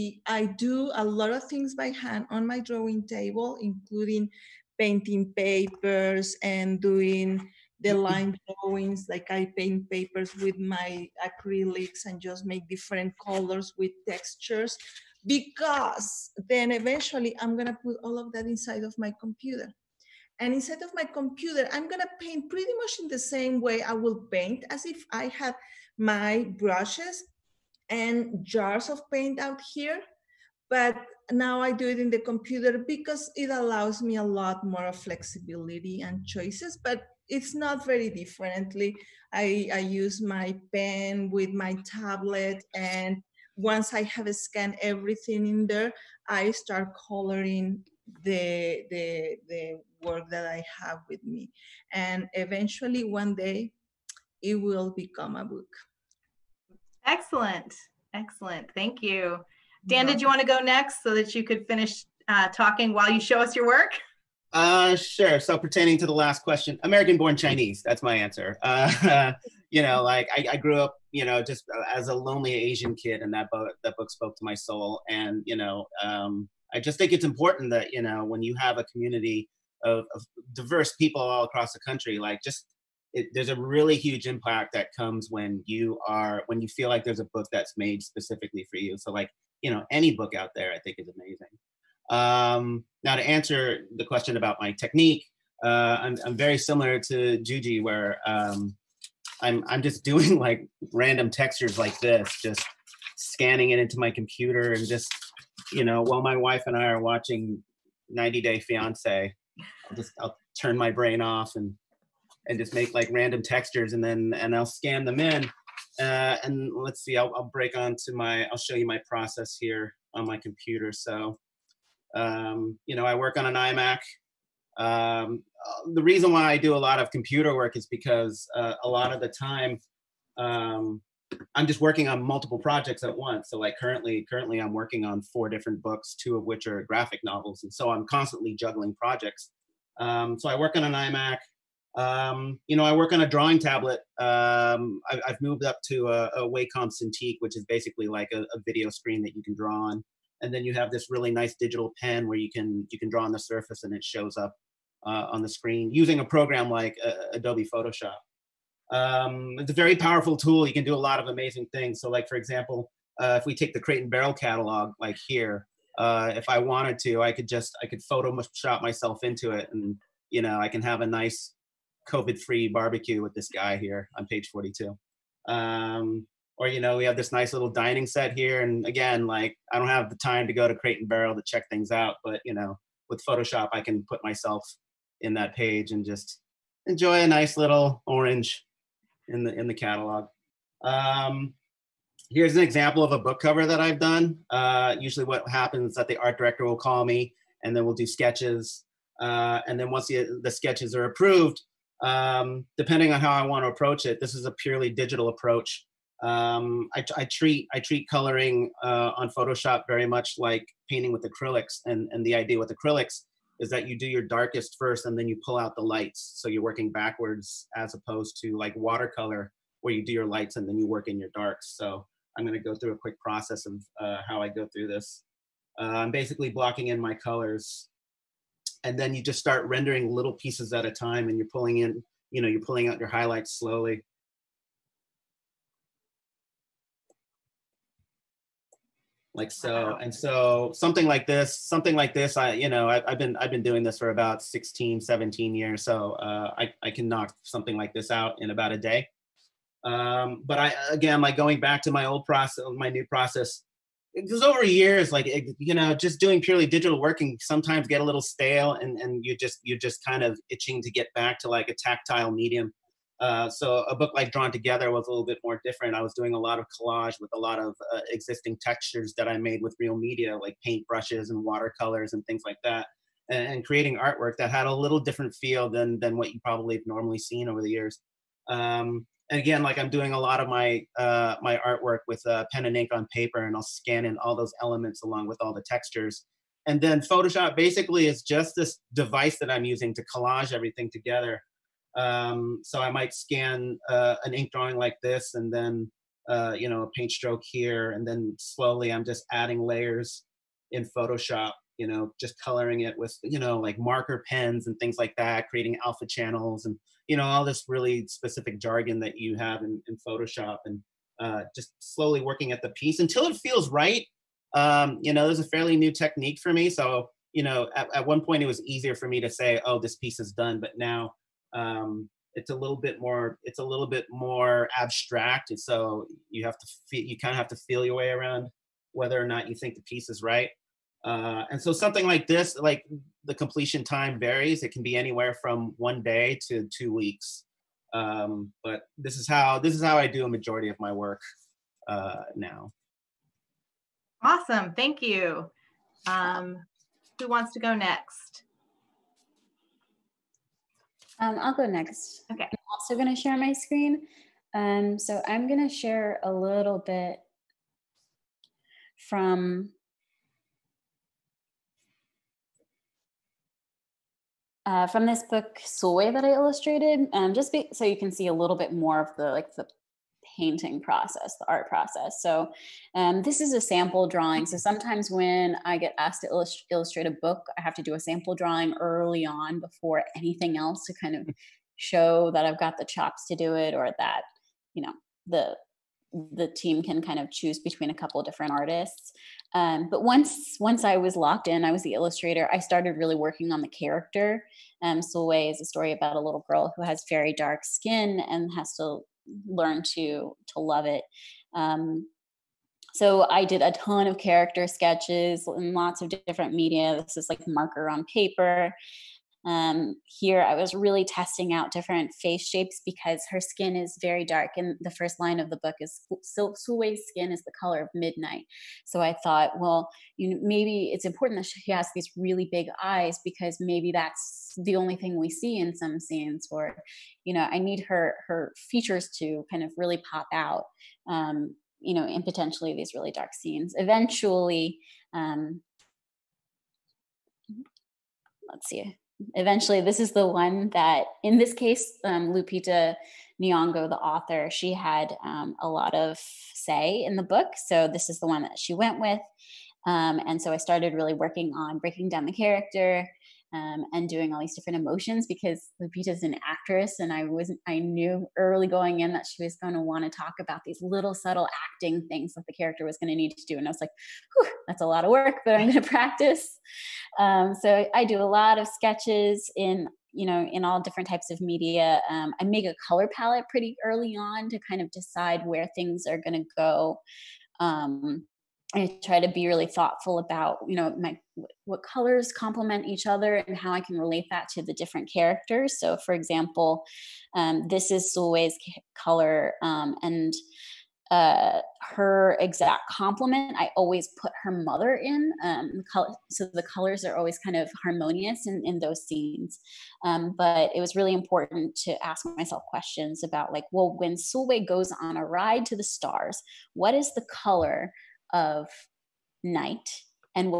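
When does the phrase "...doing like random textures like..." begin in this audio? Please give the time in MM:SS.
01:40.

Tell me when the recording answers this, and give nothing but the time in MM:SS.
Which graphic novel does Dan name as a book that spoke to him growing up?
01:06.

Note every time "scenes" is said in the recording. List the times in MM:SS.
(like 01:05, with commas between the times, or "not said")
07:05, 07:13, 08:19.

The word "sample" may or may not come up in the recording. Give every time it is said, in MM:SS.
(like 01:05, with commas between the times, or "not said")
06:13, 06:17.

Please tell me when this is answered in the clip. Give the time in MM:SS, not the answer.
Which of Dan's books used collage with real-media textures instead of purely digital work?
04:24.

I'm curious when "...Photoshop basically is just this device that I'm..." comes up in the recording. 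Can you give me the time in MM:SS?
04:46.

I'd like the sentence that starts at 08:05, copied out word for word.
So, for example, um, this is Sulwe's color, um, and uh, her exact complement, I always put her mother in.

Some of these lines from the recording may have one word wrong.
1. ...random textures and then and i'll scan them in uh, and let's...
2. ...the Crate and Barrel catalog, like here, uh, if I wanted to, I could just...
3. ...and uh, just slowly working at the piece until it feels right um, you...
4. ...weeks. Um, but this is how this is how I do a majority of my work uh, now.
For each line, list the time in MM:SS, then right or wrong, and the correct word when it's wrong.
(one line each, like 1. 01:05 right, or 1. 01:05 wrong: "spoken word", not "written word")
1. 01:53 right
2. 02:43 right
3. 05:10 right
4. 05:36 right.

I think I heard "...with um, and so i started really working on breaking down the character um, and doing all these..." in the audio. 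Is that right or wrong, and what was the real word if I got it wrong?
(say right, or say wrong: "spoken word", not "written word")
right.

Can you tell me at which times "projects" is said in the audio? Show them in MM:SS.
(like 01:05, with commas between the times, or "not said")
02:12, 02:18.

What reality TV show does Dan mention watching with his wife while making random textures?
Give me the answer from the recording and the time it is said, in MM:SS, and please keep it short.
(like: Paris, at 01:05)
90 Day Fiance, at 01:48.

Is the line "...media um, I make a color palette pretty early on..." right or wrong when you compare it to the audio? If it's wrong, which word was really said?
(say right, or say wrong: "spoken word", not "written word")
right.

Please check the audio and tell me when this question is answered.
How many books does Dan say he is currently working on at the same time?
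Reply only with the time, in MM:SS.
02:15.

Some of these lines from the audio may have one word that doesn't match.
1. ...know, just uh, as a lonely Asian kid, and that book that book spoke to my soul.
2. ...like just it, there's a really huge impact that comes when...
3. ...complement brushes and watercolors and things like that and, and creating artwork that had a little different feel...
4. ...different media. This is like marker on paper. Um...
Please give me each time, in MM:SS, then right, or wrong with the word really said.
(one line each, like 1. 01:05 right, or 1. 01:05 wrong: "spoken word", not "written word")
1. 01:11 right
2. 01:22 right
3. 04:30 wrong: "paint", not "complement"
4. 06:46 right.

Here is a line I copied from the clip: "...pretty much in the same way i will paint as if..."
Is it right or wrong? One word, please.
right.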